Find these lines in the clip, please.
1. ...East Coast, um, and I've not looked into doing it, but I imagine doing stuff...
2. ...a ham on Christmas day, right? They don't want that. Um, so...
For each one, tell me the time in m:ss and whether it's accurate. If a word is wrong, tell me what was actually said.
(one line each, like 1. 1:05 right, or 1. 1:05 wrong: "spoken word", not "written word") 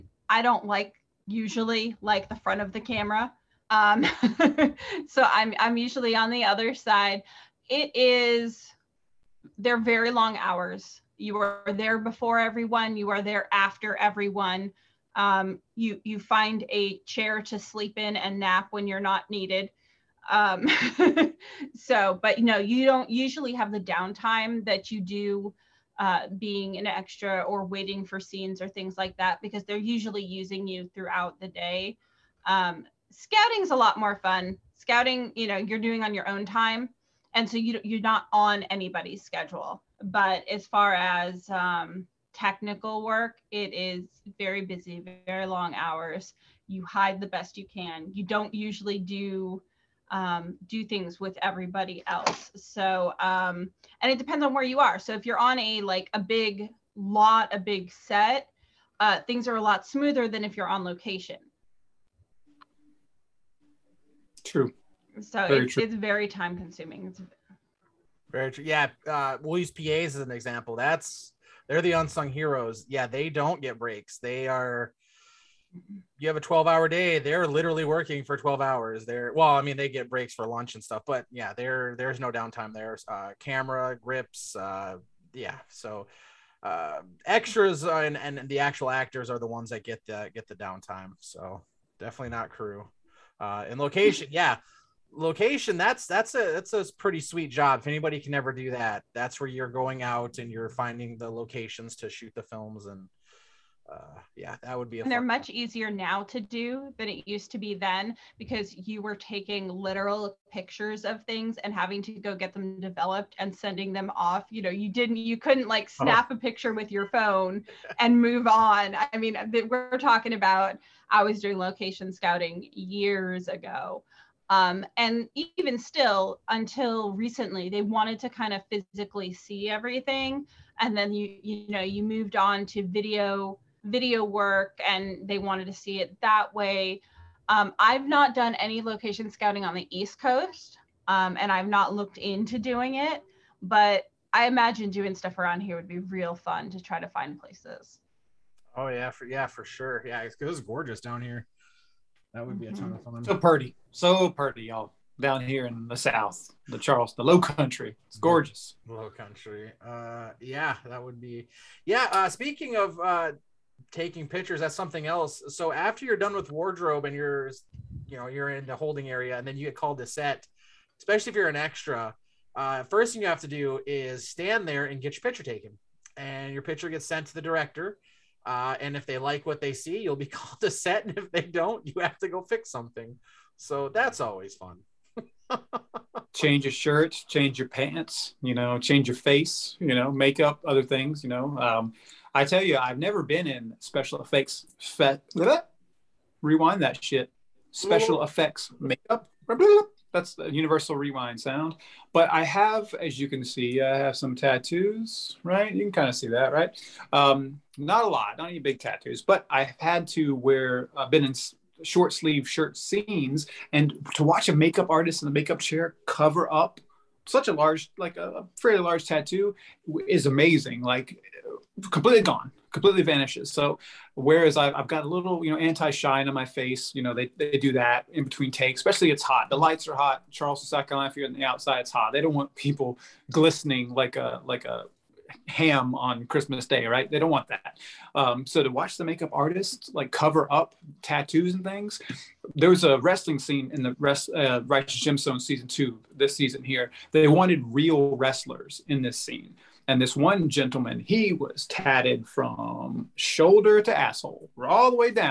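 1. 2:19 right
2. 3:54 right.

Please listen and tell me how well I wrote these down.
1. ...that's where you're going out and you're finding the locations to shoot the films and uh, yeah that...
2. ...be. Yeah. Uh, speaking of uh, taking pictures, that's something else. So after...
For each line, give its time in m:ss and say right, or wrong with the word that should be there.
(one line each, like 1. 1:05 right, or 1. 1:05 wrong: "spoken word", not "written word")
1. 1:39 right
2. 2:41 right.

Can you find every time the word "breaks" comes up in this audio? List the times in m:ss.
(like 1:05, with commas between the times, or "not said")
1:13, 1:20.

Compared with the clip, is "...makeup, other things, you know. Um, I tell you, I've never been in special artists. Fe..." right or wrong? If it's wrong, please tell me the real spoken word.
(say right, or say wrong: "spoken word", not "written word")
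wrong: "effects", not "artists".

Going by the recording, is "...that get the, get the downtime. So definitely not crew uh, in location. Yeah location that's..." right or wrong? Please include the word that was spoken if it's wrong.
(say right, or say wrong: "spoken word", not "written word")
right.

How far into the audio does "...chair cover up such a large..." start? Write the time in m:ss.
3:35.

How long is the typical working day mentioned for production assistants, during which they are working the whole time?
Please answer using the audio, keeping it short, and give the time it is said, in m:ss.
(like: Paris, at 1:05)
12 hours, at 1:16.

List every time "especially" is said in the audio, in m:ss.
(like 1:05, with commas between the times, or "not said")
2:50, 3:48.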